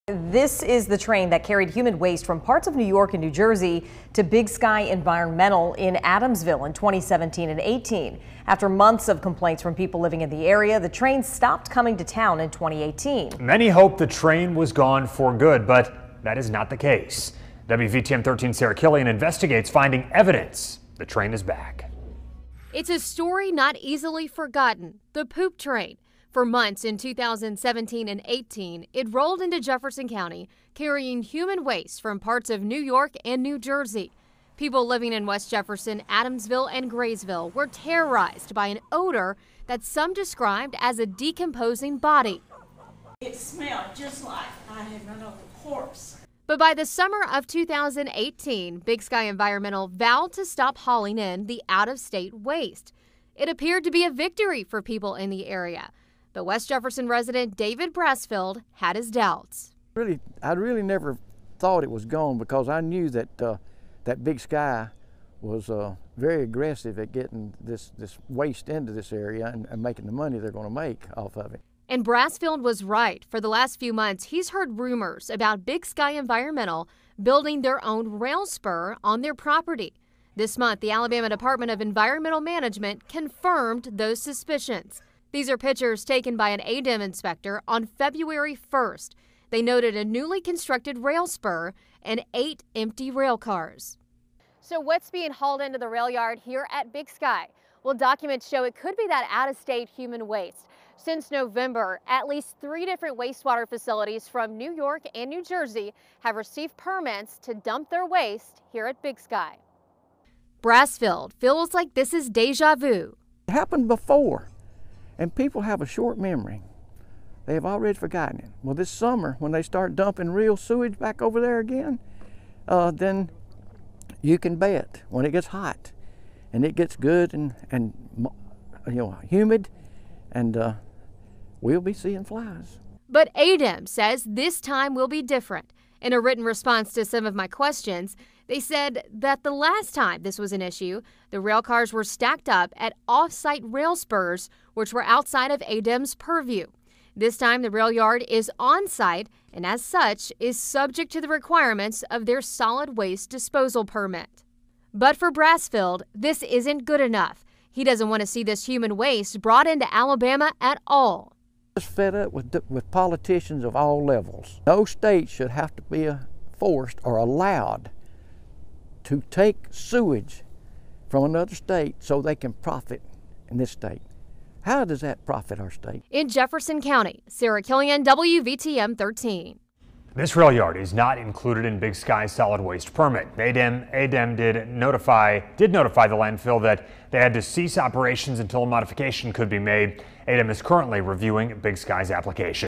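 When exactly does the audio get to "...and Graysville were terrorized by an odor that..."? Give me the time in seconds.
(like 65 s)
36 s.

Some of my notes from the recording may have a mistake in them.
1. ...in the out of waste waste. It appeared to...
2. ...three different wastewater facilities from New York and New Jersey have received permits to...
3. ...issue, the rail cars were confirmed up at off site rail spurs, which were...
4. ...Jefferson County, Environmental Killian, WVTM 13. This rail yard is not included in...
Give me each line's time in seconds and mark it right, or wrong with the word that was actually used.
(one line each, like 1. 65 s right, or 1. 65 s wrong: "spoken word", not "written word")
1. 51 s wrong: "state", not "waste"
2. 102 s right
3. 140 s wrong: "stacked", not "confirmed"
4. 176 s wrong: "Sarah", not "Environmental".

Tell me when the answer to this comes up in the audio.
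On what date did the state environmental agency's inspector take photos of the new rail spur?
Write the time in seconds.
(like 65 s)
87 s.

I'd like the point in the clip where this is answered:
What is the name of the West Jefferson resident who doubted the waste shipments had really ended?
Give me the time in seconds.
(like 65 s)
57 s.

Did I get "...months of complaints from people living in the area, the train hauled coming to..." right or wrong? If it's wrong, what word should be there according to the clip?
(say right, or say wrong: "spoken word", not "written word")
wrong: "stopped", not "hauled".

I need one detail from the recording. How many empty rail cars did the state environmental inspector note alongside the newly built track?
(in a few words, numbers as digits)
8.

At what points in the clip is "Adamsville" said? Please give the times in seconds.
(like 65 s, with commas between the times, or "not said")
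6 s, 36 s.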